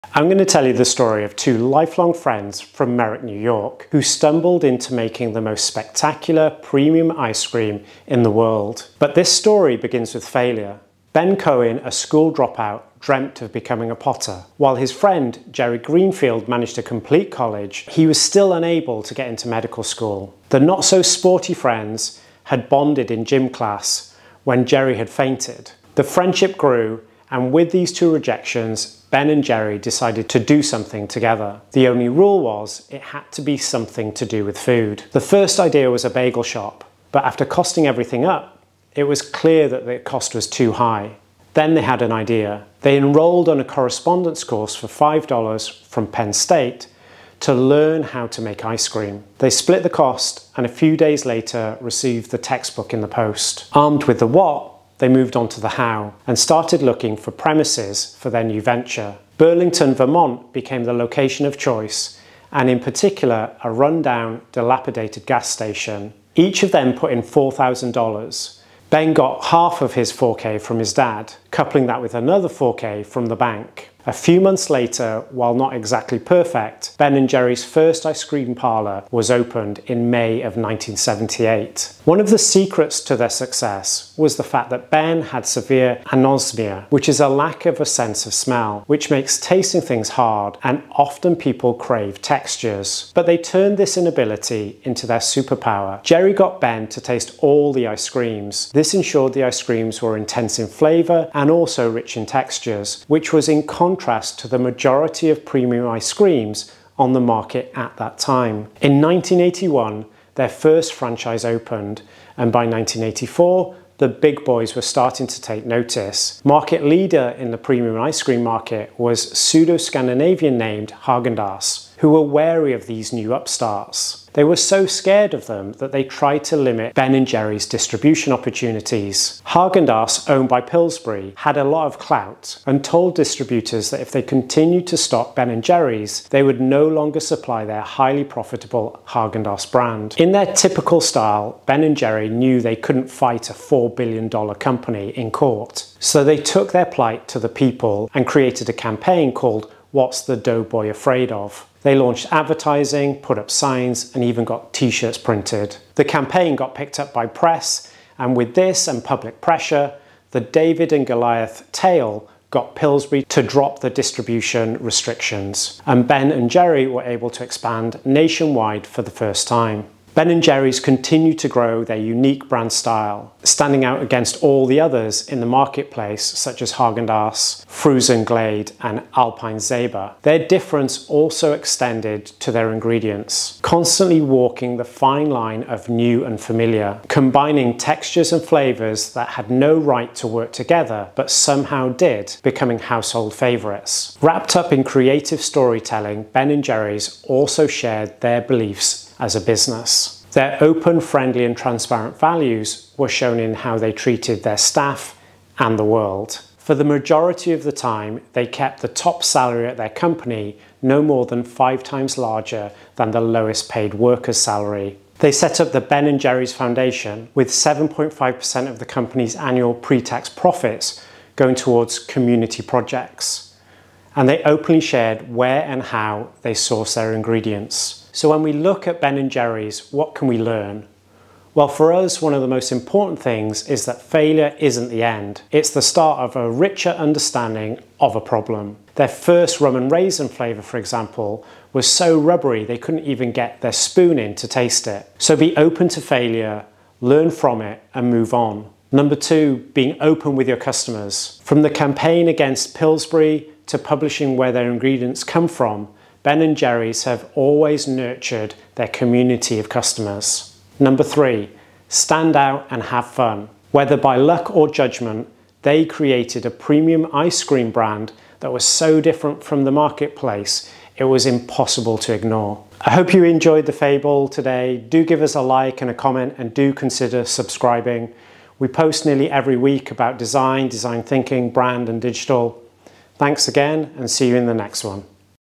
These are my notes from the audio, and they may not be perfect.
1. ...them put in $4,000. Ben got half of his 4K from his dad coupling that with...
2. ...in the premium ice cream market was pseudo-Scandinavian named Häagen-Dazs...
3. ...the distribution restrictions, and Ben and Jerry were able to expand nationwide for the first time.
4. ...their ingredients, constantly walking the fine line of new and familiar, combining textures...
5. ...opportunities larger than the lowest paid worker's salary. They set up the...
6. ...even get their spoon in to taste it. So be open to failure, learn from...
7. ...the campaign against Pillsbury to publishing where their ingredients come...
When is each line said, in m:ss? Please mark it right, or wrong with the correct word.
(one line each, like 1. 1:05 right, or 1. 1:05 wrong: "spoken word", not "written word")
1. 1:06 right
2. 1:57 right
3. 2:43 right
4. 3:02 right
5. 3:31 wrong: "times", not "opportunities"
6. 4:03 right
7. 4:11 right.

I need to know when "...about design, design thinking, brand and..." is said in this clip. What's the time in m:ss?
4:39.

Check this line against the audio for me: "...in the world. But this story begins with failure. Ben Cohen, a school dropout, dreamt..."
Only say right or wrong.
right.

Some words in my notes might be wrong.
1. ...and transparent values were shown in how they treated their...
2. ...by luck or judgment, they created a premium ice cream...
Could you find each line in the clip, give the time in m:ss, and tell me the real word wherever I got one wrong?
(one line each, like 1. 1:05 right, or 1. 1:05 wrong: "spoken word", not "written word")
1. 3:21 right
2. 4:23 right.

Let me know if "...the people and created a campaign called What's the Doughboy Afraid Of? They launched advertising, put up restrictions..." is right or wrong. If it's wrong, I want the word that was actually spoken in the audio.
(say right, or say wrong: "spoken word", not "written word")
wrong: "signs", not "restrictions".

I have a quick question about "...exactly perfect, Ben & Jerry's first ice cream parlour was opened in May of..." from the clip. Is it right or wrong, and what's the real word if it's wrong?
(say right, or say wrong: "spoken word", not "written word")
right.